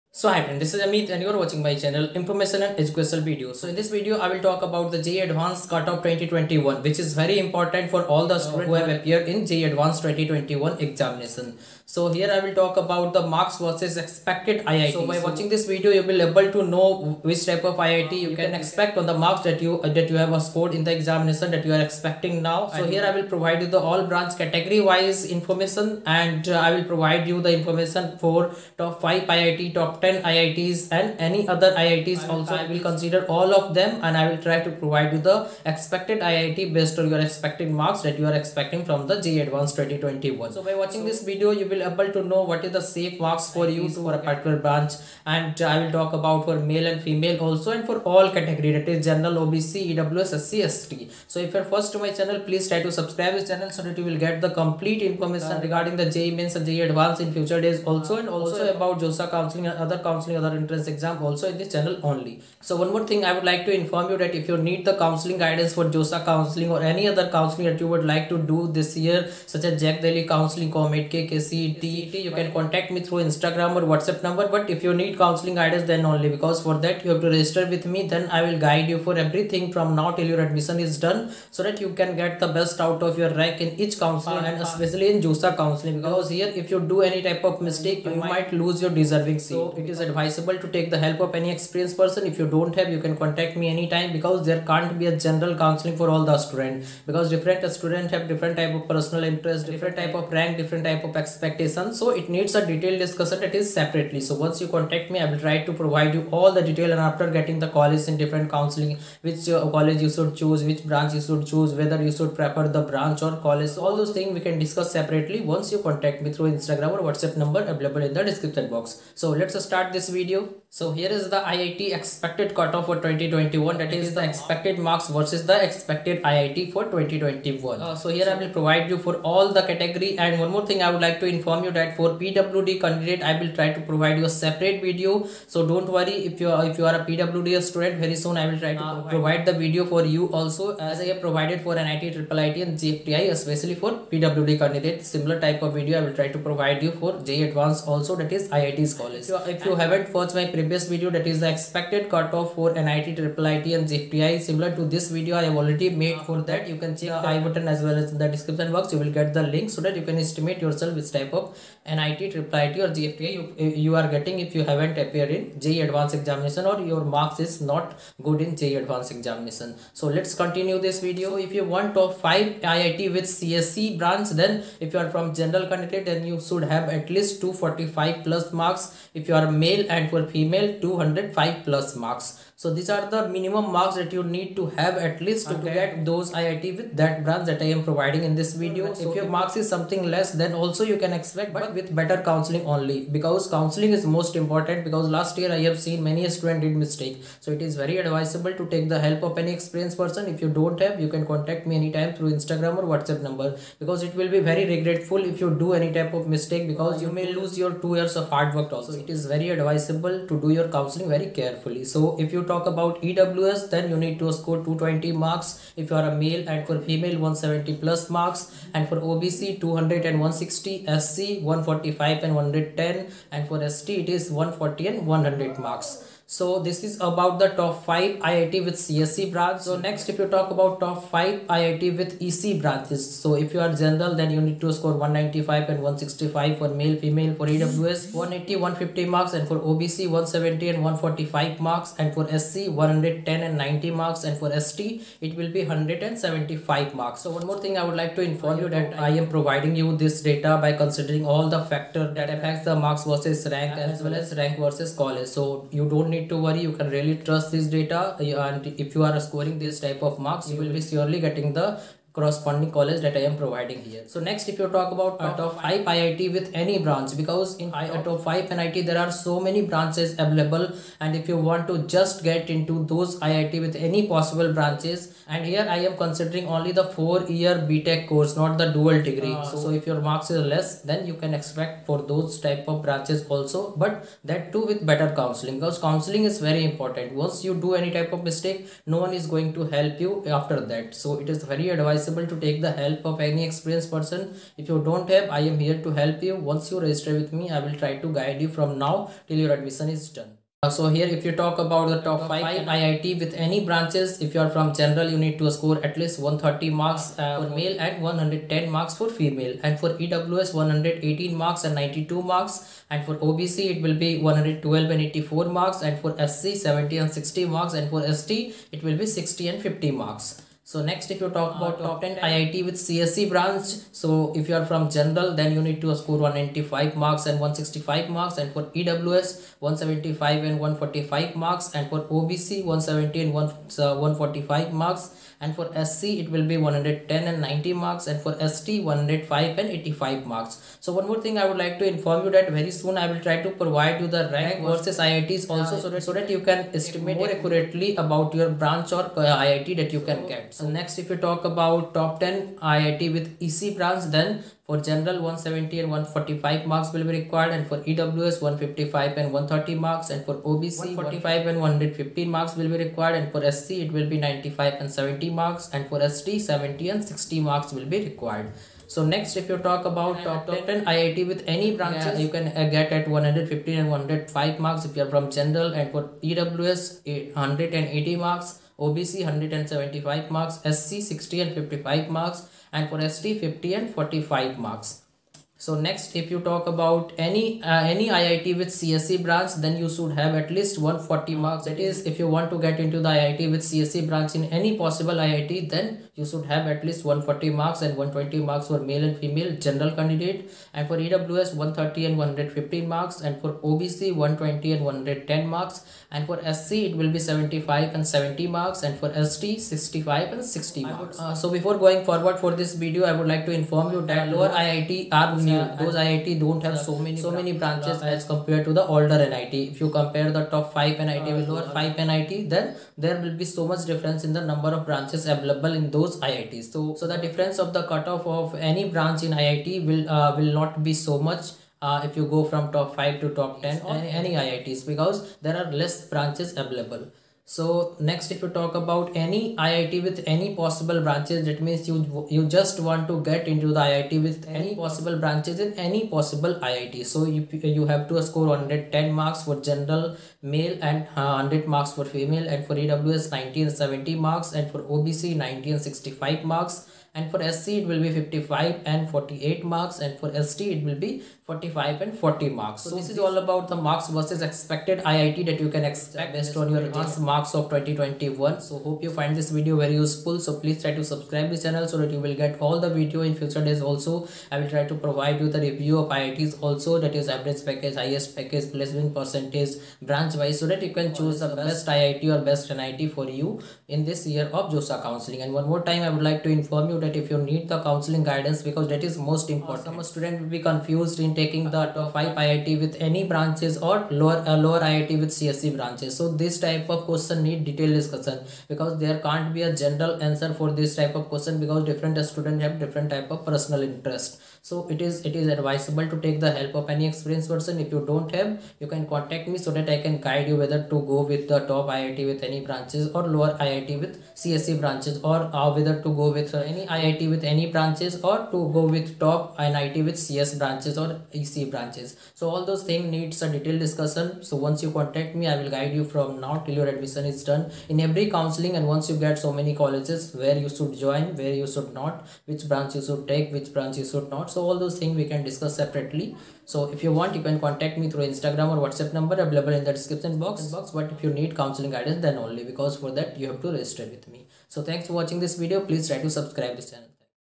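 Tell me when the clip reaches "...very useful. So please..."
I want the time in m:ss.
7:49.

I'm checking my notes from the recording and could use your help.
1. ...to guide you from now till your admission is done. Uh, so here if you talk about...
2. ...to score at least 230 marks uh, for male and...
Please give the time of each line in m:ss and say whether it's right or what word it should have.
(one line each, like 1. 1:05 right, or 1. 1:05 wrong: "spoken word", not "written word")
1. 4:57 right
2. 5:05 wrong: "130", not "230".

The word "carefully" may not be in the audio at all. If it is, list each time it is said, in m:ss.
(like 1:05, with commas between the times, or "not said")
3:31.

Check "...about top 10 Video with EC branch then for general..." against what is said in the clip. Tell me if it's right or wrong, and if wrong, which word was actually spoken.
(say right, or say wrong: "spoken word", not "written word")
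wrong: "IIT", not "Video".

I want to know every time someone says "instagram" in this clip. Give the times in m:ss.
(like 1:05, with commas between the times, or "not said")
1:13, 1:56, 3:22, 8:58.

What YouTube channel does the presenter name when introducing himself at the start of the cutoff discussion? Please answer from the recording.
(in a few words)
Information and Educational Video.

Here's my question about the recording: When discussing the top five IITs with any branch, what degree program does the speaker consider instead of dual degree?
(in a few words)
4 year BTech.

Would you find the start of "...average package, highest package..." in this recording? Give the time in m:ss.
7:57.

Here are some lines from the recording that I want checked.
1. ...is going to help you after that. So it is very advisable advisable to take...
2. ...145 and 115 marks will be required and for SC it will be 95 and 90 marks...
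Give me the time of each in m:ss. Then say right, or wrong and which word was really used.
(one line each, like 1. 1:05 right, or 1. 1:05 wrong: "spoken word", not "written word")
1. 4:49 right
2. 6:00 wrong: "70", not "90".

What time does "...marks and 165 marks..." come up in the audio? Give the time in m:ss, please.
5:26.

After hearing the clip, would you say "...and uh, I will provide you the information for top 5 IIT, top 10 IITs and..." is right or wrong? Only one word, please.
right.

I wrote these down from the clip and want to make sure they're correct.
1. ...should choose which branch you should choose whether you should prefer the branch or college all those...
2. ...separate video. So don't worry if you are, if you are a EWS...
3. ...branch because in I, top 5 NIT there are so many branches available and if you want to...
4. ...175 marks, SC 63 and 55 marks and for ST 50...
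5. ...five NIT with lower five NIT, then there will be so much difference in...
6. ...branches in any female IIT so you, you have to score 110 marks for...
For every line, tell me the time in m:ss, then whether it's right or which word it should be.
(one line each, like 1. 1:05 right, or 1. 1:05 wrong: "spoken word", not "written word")
1. 1:50 right
2. 2:14 wrong: "PWD", not "EWS"
3. 4:26 right
4. 6:19 wrong: "60", not "63"
5. 7:00 right
6. 7:25 wrong: "possible", not "female".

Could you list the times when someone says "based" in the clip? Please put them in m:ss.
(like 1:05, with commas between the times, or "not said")
0:36, 7:46.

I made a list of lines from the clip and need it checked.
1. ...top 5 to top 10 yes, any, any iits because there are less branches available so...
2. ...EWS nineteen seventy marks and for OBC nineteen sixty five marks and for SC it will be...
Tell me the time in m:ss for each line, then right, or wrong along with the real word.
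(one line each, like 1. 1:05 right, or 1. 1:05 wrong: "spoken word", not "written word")
1. 7:12 right
2. 7:32 right.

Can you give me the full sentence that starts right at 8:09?
Some student will be confused in taking the top 5 IIT with any branches or lower uh, lower IIT with CSE branches.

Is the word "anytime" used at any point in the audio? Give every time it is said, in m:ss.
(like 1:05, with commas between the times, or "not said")
1:33, 3:21.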